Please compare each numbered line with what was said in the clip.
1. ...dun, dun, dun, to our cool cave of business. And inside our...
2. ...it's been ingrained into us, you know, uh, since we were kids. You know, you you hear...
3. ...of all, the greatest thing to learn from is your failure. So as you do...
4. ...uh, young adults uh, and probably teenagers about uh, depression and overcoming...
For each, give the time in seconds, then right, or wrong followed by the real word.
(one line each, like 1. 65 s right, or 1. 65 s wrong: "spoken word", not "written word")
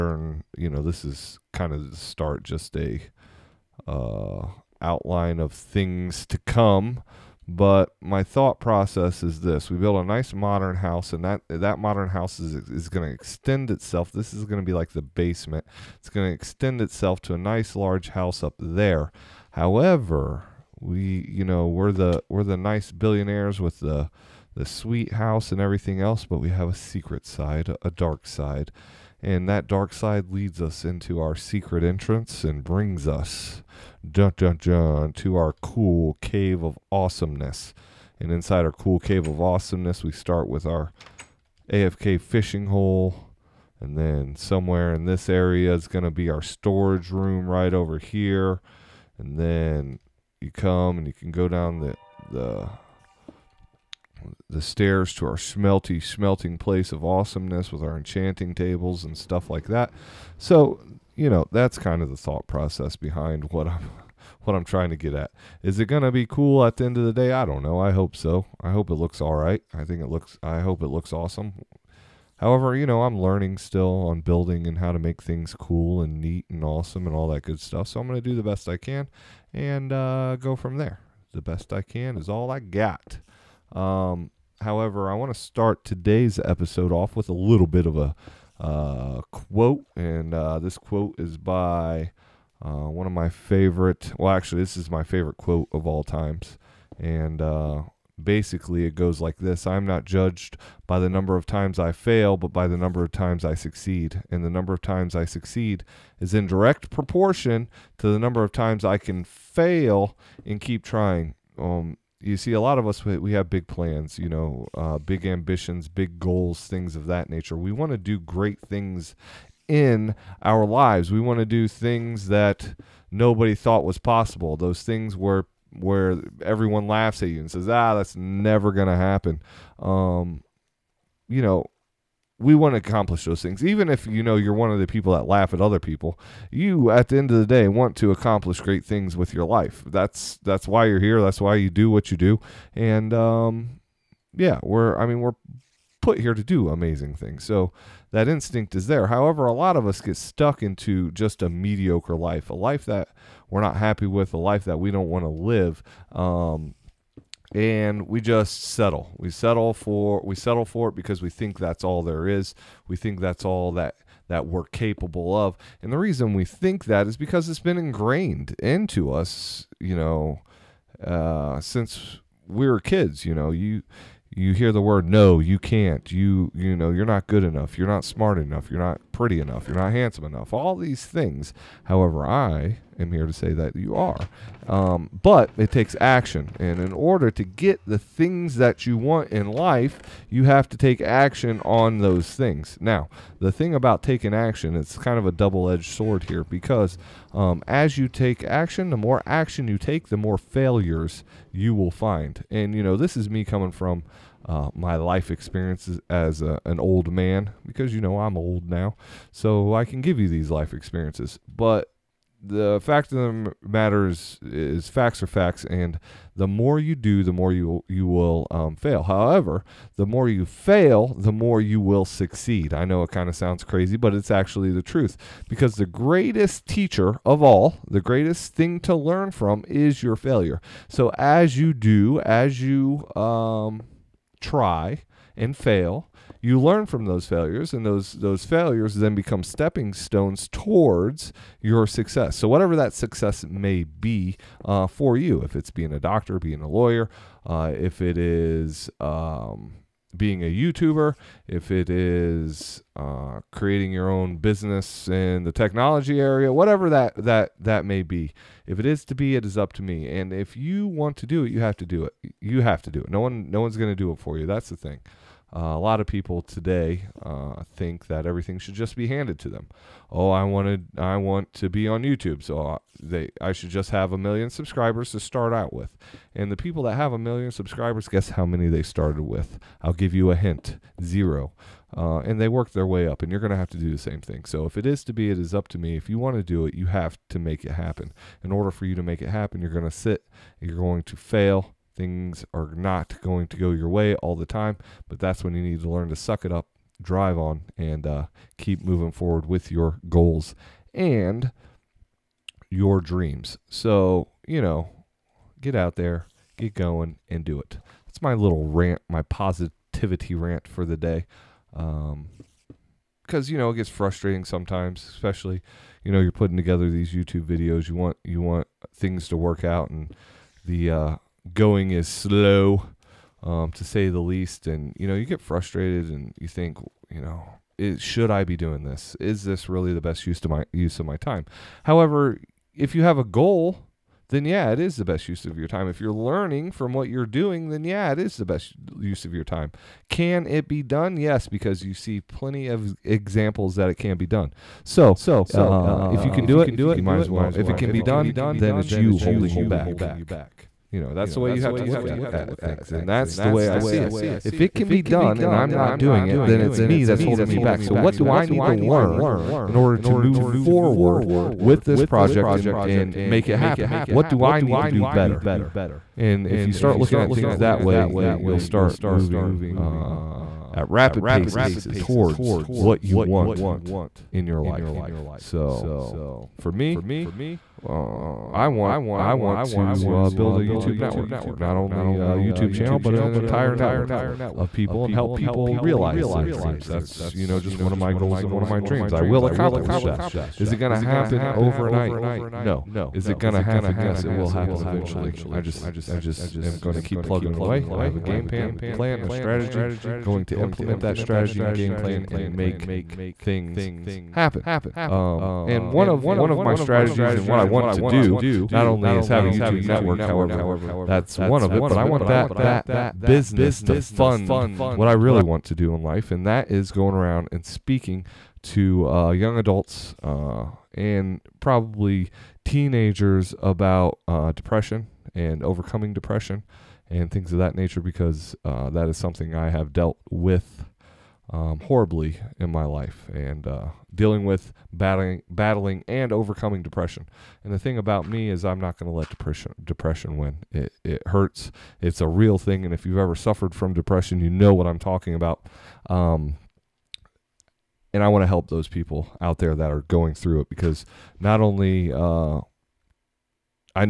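1. 34 s wrong: "awesomeness", not "business"
2. 167 s right
3. 227 s right
4. 419 s right.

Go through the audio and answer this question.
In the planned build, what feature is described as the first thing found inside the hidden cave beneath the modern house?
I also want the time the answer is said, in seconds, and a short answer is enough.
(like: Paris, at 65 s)
AFK fishing hole, at 41 s.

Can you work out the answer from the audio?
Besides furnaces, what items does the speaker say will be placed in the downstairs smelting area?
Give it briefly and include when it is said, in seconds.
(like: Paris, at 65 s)
enchanting tables, at 57 s.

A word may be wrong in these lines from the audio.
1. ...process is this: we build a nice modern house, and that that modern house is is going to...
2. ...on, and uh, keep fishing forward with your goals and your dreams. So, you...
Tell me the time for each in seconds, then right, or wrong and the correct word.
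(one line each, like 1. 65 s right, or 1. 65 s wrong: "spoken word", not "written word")
1. 8 s right
2. 297 s wrong: "moving", not "fishing".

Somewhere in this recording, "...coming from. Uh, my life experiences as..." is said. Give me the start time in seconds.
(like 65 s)
203 s.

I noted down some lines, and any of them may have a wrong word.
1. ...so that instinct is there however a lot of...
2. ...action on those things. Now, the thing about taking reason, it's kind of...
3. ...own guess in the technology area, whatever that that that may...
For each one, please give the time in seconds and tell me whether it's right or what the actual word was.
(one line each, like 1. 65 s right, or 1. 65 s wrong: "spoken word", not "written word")
1. 147 s right
2. 191 s wrong: "action", not "reason"
3. 254 s wrong: "business", not "guess".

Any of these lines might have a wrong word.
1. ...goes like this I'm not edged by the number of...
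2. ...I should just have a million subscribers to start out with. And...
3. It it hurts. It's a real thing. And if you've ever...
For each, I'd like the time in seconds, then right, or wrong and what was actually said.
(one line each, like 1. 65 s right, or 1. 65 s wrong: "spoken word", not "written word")
1. 98 s wrong: "judged", not "edged"
2. 273 s right
3. 440 s right.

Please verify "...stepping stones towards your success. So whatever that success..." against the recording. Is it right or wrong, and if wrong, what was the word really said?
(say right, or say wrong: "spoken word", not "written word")
right.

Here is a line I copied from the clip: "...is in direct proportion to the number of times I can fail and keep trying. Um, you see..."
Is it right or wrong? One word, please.
right.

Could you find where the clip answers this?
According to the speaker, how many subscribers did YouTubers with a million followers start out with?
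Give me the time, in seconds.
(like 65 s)
281 s.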